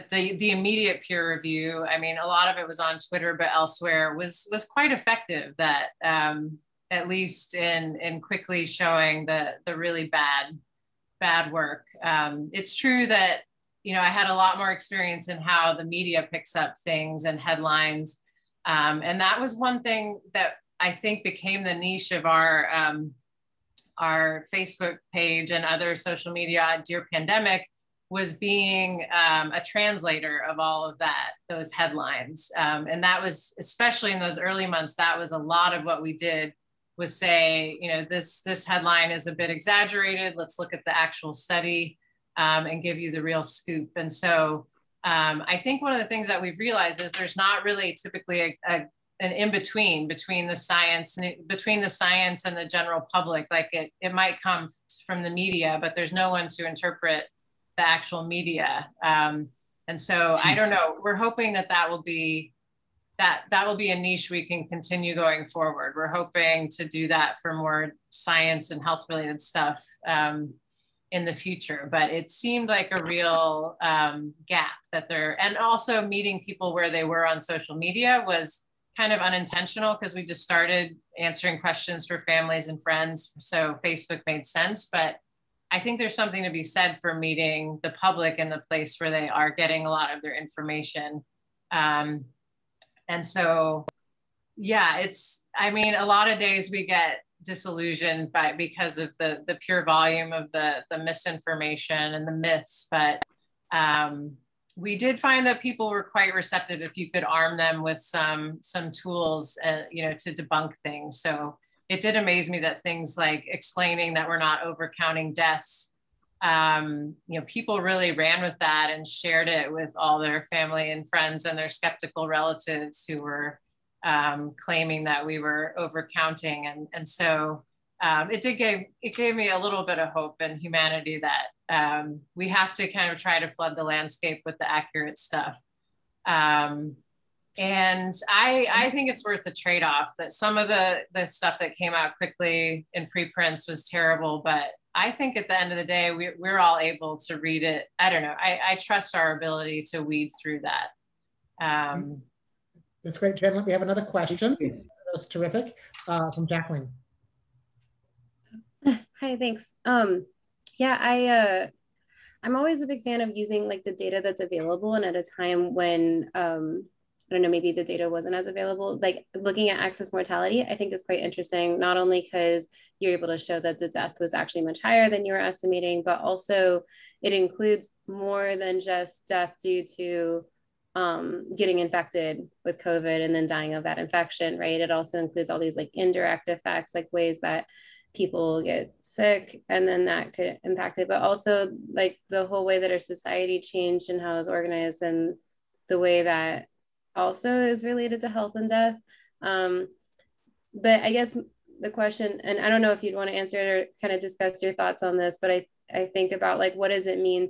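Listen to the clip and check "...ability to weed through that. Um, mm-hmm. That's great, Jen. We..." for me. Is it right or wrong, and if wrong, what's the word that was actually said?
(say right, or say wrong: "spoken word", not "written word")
right.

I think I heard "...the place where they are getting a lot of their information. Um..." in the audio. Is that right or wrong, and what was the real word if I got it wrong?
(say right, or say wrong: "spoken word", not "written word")
right.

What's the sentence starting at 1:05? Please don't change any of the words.
We're hoping to do that for more science and health related stuff um, in the future.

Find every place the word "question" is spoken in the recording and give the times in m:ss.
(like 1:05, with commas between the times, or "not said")
1:21, 2:34, 3:21.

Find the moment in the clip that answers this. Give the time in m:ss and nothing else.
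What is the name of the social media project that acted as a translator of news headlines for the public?
0:26.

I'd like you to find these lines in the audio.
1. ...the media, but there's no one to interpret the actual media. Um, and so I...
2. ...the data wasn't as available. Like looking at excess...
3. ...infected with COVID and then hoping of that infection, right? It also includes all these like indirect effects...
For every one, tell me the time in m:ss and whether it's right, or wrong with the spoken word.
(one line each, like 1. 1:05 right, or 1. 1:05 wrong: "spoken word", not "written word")
1. 0:55 right
2. 2:47 right
3. 3:01 wrong: "dying", not "hoping".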